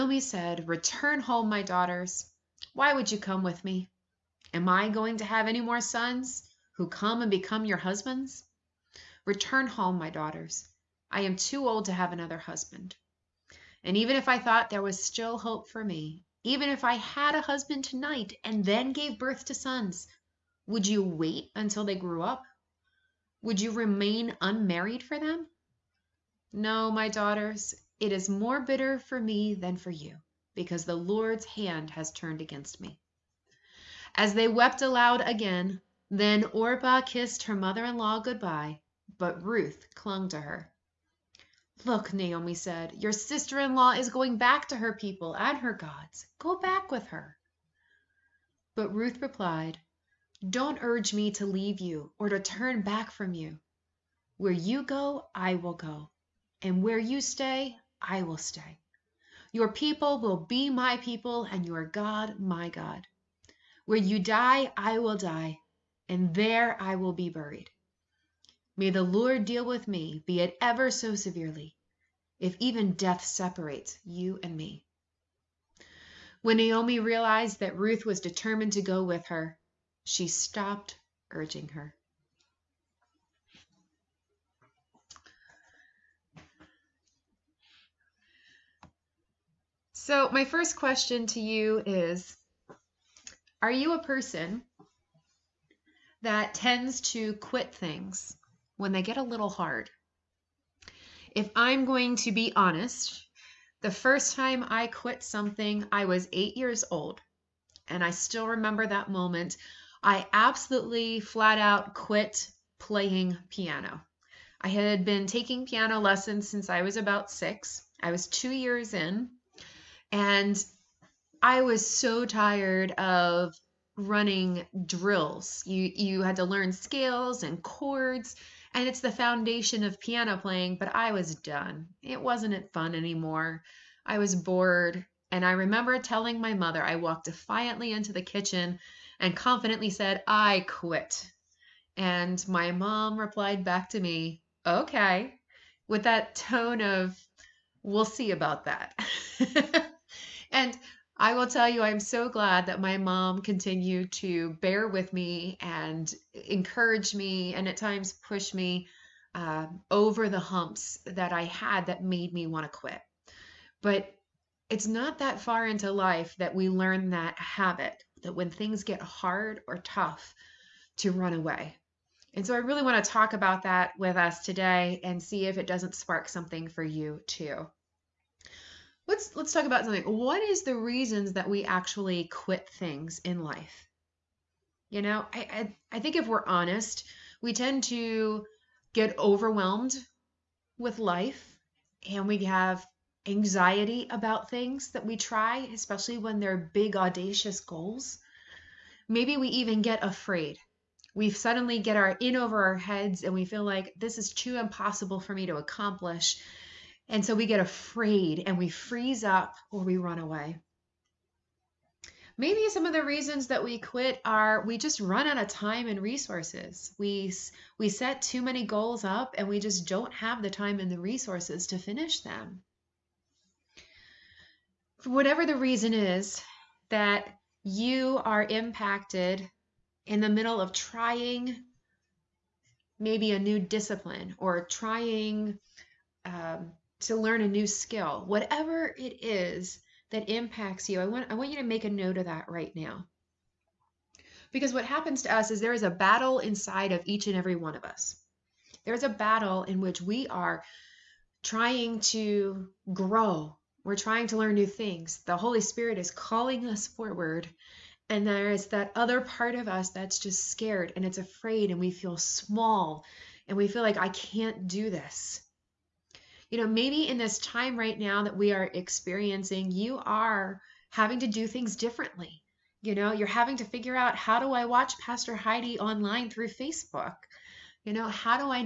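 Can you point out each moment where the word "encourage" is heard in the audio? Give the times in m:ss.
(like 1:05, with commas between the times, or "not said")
2:36.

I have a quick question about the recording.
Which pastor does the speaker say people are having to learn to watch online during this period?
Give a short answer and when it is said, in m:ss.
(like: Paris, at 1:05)
Pastor Heidi, at 4:34.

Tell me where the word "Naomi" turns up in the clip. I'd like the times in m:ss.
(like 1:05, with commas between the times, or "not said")
0:42, 1:16.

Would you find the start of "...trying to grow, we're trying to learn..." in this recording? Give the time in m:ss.
4:11.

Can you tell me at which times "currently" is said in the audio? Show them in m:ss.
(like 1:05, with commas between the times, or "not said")
not said.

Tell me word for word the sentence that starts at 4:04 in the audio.
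Because what happens to us is there is a battle inside of each and every one of us.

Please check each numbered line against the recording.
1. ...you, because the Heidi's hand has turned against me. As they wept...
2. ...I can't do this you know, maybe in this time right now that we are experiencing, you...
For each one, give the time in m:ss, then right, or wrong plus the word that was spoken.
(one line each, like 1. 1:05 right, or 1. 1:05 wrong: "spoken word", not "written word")
1. 0:29 wrong: "Lord", not "Heidi"
2. 4:23 right.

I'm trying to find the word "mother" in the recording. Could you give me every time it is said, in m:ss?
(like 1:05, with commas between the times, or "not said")
0:37, 2:16.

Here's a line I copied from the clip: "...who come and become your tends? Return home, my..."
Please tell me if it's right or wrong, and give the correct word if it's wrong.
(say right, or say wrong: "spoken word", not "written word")
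wrong: "husbands", not "tends".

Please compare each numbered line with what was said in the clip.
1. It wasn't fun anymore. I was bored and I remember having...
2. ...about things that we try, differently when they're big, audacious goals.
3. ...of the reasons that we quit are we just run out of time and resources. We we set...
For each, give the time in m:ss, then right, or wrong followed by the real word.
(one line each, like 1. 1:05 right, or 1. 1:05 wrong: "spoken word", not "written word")
1. 2:12 wrong: "telling", not "having"
2. 3:14 wrong: "especially", not "differently"
3. 3:32 right.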